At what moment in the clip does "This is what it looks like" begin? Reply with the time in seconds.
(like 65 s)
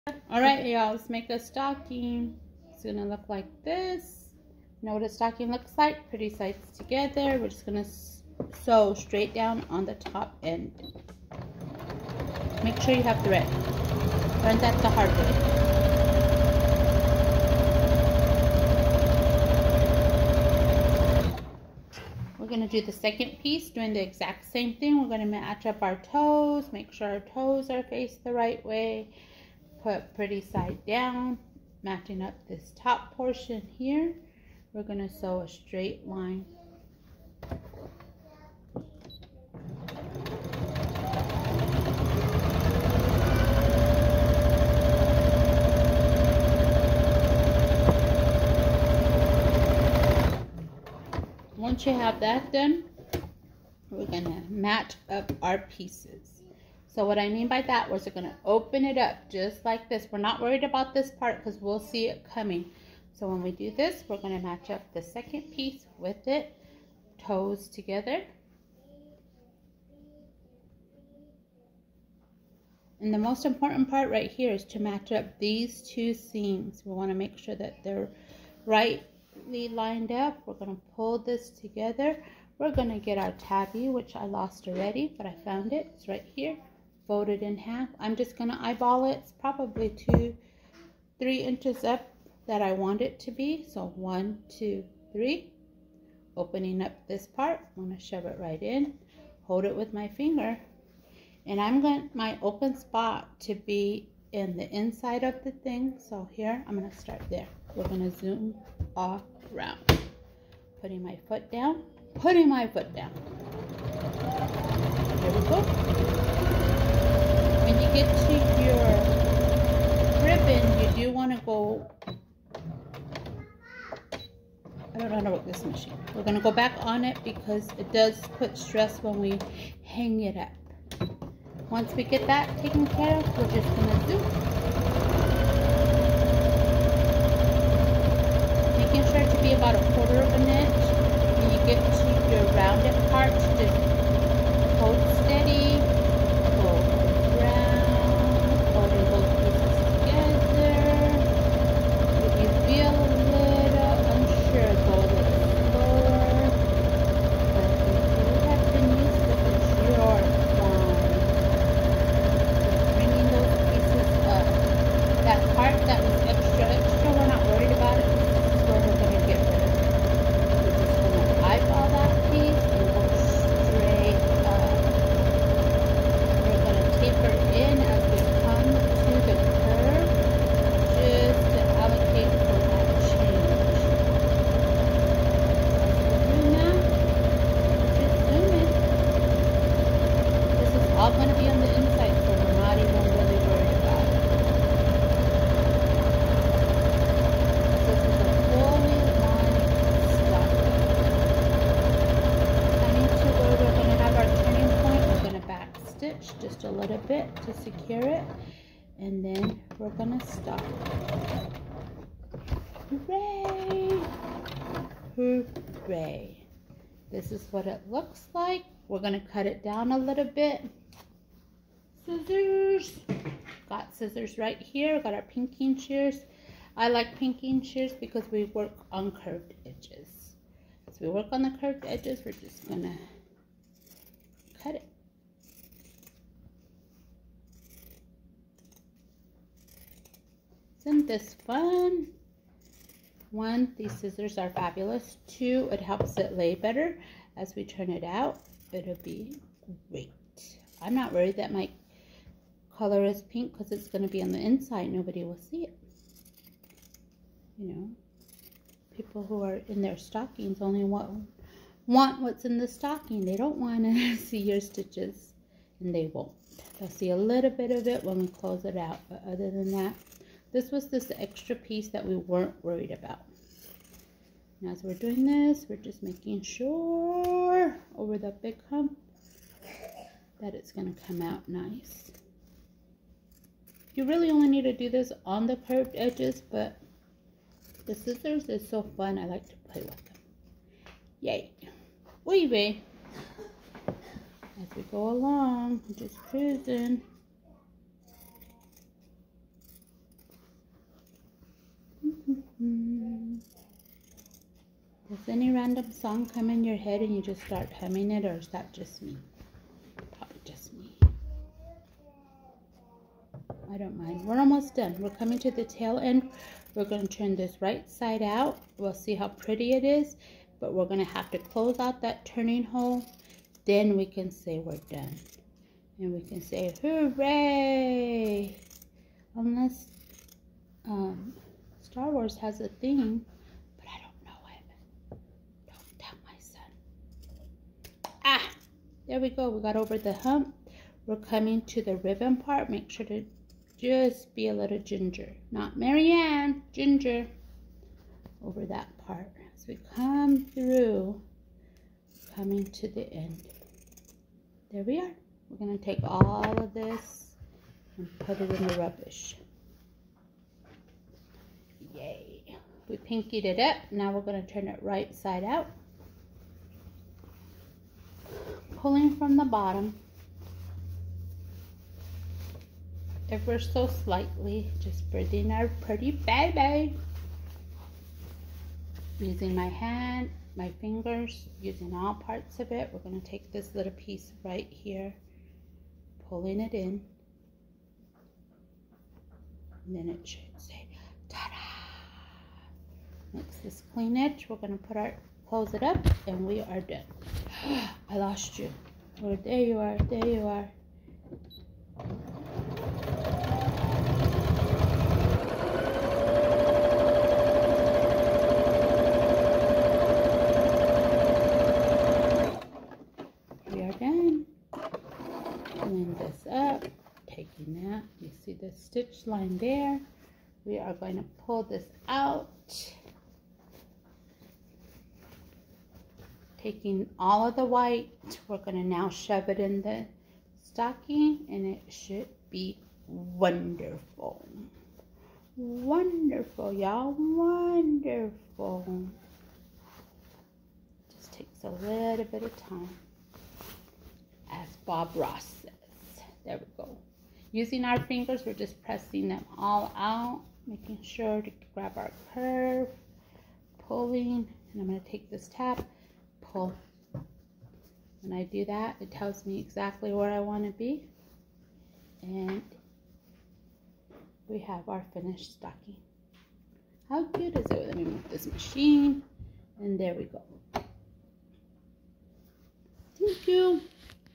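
217 s.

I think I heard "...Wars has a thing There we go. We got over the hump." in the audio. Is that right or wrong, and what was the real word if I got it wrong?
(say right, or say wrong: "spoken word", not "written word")
right.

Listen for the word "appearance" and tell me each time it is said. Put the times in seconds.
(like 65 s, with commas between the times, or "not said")
not said.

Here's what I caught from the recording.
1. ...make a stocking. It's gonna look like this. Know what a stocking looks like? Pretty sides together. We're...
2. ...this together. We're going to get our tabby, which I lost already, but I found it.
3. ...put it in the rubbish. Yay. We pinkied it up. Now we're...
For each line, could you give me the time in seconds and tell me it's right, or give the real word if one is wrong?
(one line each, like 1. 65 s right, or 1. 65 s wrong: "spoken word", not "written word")
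1. 1 s right
2. 81 s right
3. 358 s right.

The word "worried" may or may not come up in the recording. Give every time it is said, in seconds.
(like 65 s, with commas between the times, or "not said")
60 s, 251 s, 272 s.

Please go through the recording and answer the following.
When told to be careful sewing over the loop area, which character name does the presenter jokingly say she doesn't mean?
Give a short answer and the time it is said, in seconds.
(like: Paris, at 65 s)
Mary Ann, at 345 s.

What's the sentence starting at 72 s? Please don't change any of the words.
And the most important part right here is to match up these two seams.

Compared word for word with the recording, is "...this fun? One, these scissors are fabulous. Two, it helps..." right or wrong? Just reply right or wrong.
right.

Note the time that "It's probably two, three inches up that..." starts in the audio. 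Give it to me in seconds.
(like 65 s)
89 s.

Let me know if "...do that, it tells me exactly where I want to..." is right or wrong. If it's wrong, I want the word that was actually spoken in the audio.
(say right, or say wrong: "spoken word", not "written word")
right.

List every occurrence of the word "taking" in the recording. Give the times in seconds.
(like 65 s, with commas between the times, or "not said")
417 s, 426 s.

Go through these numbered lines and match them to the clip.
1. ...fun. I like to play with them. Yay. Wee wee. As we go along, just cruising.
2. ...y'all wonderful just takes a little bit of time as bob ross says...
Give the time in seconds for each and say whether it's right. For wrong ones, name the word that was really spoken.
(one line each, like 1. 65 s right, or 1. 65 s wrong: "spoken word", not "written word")
1. 288 s right
2. 436 s right.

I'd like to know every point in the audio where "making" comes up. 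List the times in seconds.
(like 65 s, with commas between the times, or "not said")
138 s, 276 s, 450 s.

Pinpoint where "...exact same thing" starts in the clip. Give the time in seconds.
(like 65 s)
24 s.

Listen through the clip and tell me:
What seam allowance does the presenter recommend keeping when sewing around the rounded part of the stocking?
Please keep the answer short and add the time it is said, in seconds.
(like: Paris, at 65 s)
a quarter of an inch, at 139 s.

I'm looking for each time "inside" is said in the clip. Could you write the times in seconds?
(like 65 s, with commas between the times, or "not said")
104 s, 254 s.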